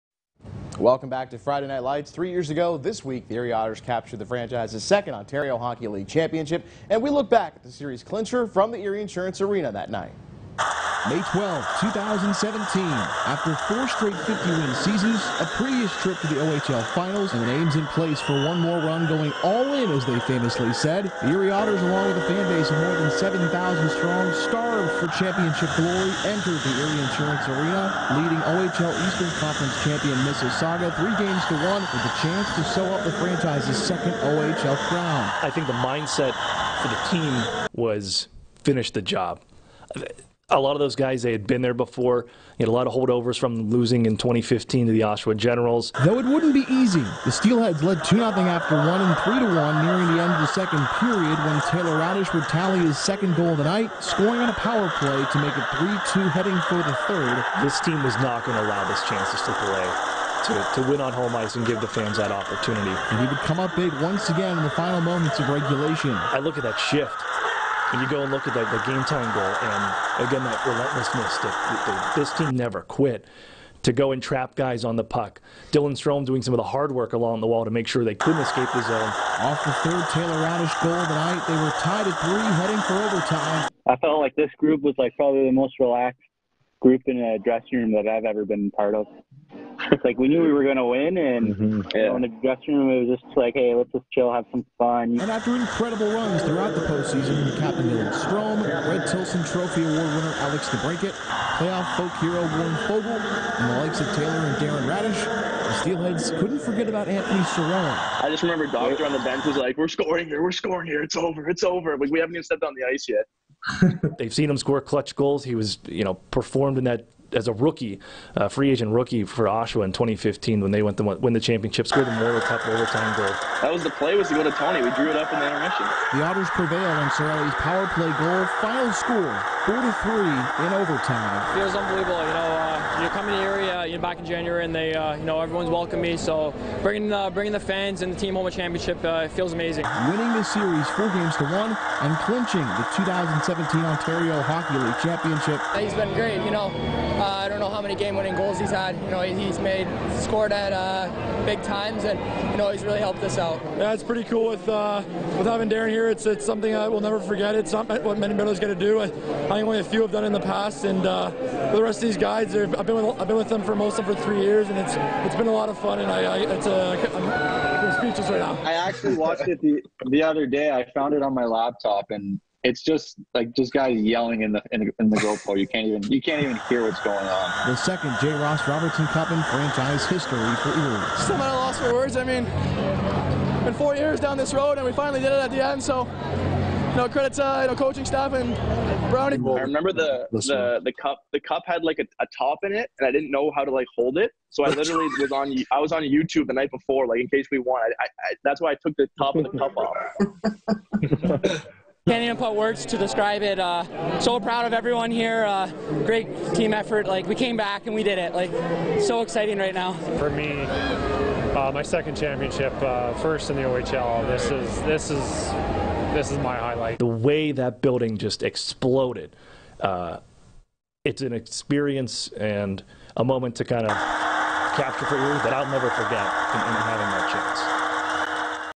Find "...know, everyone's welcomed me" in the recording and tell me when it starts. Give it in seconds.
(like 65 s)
135 s.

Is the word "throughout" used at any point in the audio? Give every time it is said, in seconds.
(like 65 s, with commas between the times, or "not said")
96 s.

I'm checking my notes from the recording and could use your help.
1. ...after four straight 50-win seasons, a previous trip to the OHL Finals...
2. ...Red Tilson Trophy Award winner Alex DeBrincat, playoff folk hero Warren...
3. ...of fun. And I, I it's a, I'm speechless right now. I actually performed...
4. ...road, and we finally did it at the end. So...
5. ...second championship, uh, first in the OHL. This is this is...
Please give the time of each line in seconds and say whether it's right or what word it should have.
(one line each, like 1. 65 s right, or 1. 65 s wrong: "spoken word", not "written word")
1. 13 s right
2. 98 s right
3. 165 s wrong: "watched", not "performed"
4. 184 s right
5. 211 s right.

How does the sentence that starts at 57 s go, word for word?
This team was not going to allow this chance to slip away.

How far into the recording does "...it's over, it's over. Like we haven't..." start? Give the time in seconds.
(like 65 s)
111 s.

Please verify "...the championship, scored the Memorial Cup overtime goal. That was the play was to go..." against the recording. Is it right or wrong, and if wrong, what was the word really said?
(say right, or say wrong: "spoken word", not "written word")
right.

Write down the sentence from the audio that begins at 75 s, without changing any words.
Dylan Strome doing some of the hard work along the wall to make sure they couldn't escape the zone.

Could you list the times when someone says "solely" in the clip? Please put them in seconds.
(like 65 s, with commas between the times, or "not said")
not said.